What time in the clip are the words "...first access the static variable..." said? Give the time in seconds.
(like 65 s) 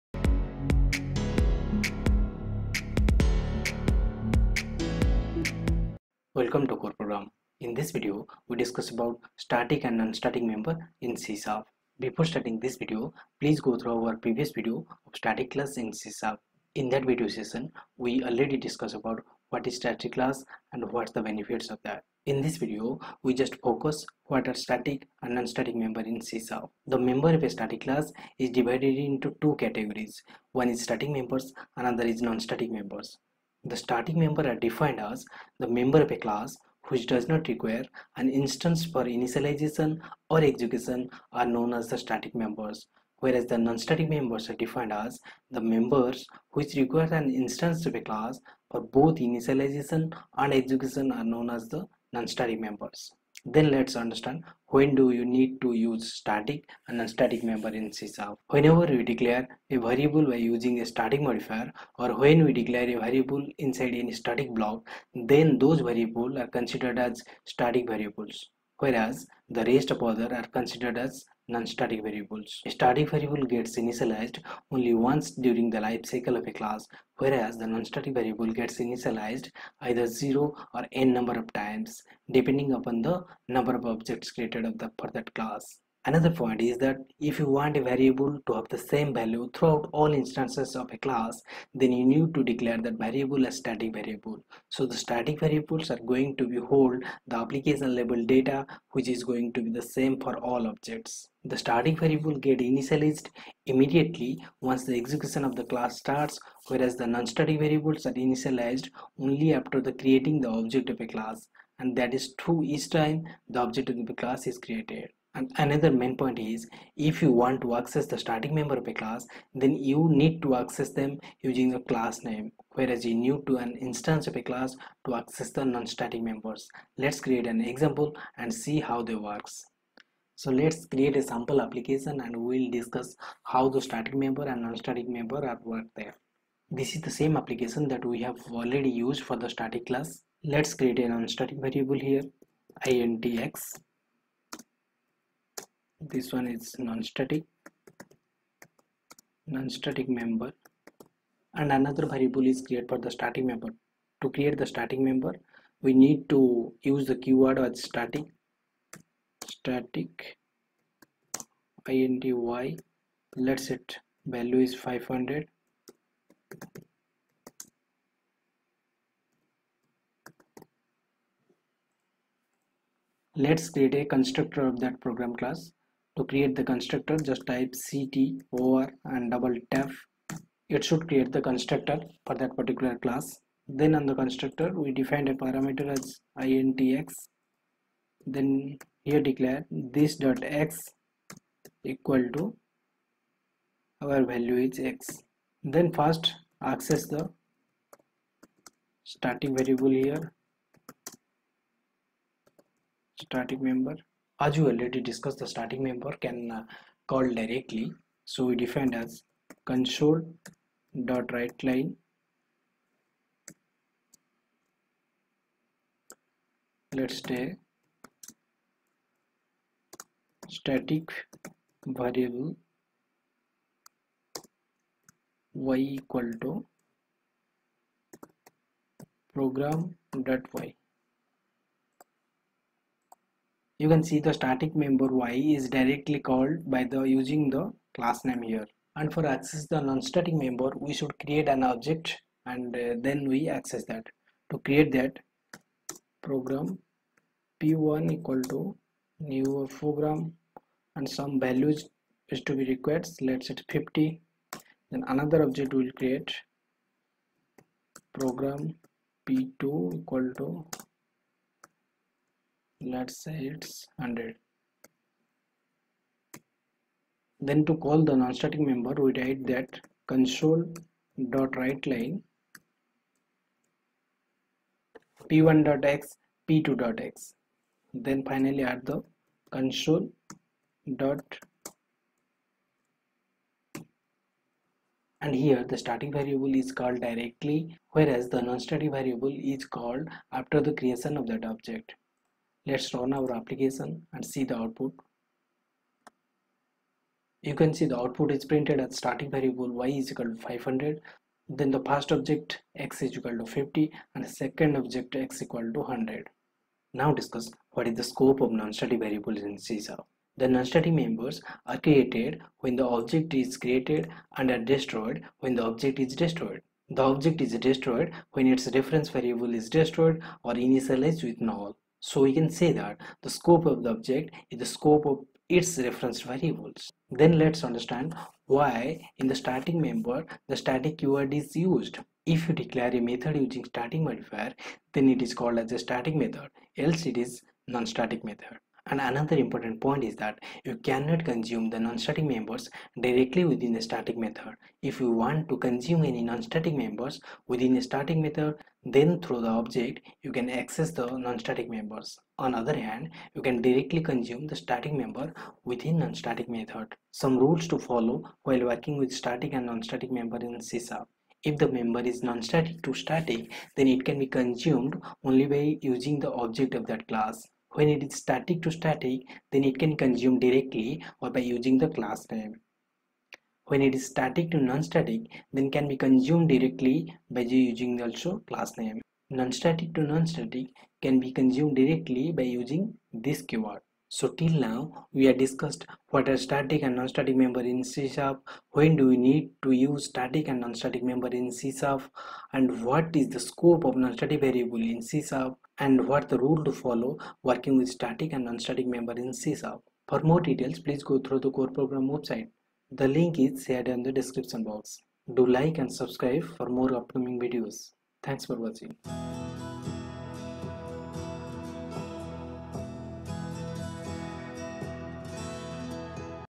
195 s.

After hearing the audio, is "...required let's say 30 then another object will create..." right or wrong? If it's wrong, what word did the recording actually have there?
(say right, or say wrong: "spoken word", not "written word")
wrong: "50", not "30".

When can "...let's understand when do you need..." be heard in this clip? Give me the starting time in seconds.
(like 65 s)
53 s.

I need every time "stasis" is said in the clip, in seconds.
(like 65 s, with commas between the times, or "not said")
not said.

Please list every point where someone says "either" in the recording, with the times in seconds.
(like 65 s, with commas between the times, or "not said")
79 s.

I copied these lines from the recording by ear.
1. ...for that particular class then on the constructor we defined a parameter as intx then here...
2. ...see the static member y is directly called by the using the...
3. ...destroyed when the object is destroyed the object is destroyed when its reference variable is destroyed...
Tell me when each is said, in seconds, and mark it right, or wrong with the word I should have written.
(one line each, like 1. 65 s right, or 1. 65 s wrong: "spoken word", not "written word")
1. 182 s right
2. 234 s right
3. 314 s right.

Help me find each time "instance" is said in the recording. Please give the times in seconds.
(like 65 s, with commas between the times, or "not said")
38 s, 47 s, 90 s, 123 s.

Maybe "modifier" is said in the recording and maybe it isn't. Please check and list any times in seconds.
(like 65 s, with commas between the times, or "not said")
61 s, 334 s.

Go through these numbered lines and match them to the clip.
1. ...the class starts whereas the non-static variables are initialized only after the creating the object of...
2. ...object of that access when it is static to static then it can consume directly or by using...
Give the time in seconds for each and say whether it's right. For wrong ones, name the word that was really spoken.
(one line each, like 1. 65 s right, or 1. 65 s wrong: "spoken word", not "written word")
1. 105 s right
2. 366 s wrong: "class", not "access".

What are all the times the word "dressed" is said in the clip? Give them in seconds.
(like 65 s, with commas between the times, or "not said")
not said.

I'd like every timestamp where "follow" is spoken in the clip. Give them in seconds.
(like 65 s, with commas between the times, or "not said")
357 s, 396 s.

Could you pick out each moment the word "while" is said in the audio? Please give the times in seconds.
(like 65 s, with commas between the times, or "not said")
358 s.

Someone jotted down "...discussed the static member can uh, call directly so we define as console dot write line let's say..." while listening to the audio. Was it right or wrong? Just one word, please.
right.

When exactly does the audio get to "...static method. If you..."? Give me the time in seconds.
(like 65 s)
343 s.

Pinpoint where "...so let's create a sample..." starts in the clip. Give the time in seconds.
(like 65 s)
130 s.